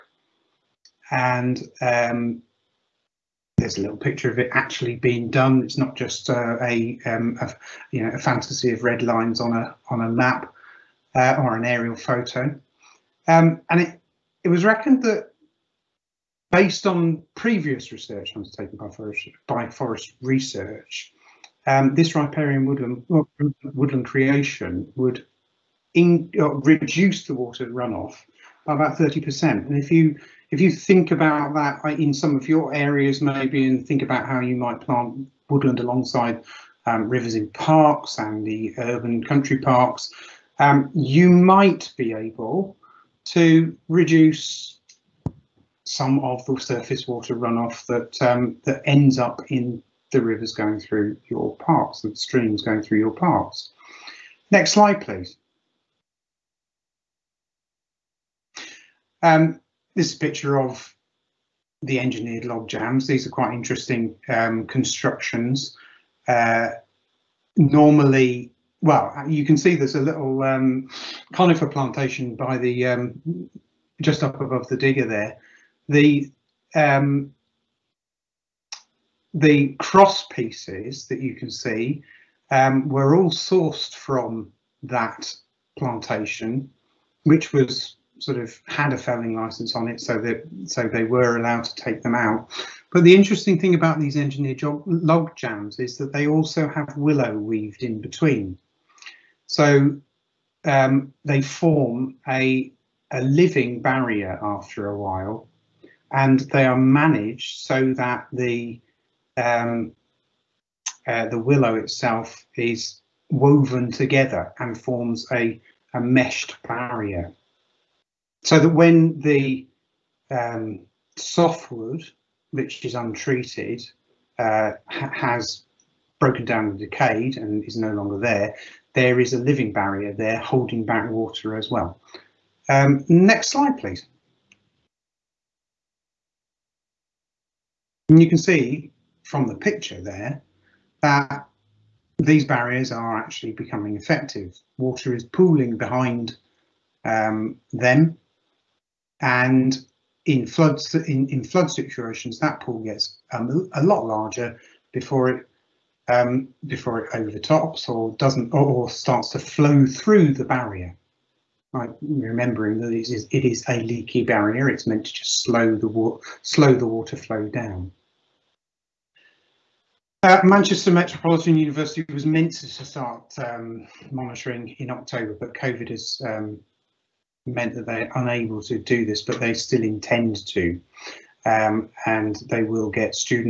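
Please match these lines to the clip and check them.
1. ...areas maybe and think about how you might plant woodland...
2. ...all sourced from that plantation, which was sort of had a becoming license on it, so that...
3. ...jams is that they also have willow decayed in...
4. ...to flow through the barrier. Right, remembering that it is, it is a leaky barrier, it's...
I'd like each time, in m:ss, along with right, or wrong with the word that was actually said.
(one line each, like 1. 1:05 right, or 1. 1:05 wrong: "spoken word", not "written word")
1. 0:32 right
2. 1:23 wrong: "felling", not "becoming"
3. 1:35 wrong: "weaved", not "decayed"
4. 2:39 right.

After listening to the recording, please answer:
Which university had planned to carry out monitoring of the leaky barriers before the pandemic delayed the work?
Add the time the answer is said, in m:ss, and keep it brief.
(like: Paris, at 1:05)
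Manchester Metropolitan University, at 2:50.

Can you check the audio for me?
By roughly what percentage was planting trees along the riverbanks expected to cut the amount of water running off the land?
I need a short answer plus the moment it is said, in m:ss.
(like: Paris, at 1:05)
30%, at 0:28.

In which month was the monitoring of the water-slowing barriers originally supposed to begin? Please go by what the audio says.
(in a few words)
October.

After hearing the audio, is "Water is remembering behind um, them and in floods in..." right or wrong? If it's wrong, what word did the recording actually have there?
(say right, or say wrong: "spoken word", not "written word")
wrong: "pooling", not "remembering".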